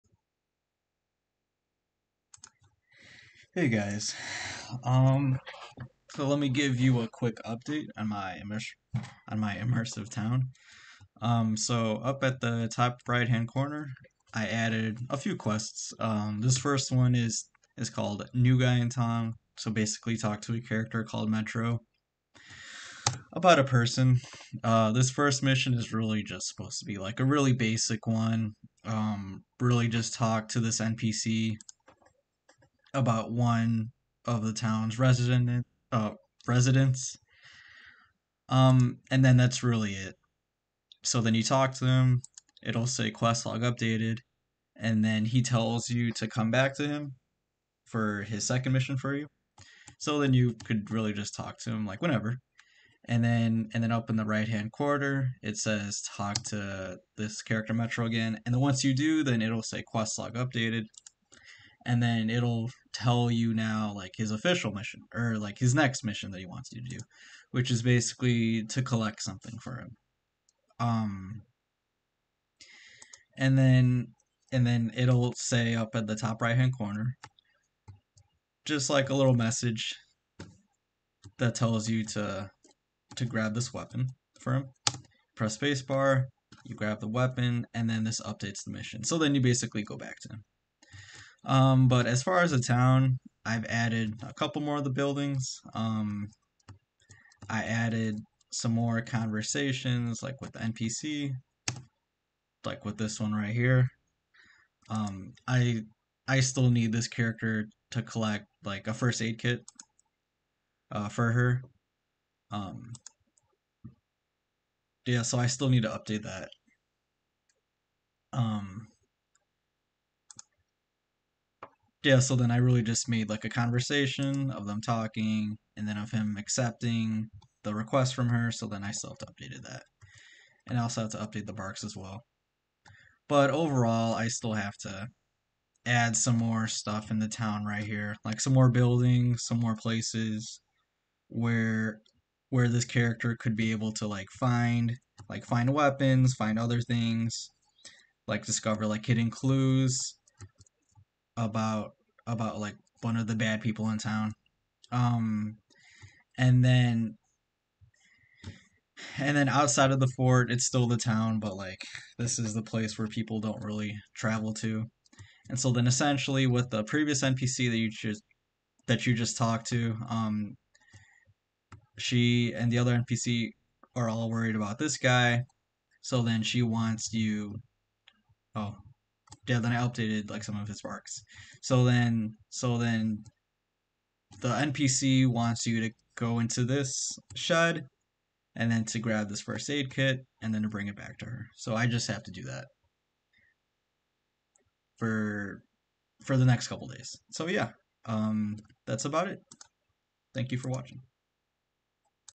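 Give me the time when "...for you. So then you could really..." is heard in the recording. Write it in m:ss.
0:48.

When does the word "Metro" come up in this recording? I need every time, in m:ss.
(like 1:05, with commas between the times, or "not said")
0:21, 0:57.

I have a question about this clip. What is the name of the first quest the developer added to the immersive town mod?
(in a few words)
New Guy in Town.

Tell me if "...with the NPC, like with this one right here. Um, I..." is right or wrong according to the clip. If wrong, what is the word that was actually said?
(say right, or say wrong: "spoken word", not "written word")
right.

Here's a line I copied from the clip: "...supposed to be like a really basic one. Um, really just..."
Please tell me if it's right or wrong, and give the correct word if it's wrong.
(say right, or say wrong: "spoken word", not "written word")
right.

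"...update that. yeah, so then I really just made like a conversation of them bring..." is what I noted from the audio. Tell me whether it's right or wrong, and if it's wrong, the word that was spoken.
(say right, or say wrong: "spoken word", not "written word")
wrong: "talking", not "bring".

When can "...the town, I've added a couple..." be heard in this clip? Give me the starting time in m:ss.
1:32.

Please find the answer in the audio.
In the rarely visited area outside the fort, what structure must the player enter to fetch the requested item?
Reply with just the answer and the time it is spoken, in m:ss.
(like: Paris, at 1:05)
Shed, at 3:07.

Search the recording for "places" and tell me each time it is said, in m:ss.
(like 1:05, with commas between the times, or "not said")
2:19, 2:42.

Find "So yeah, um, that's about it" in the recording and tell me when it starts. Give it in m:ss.
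3:17.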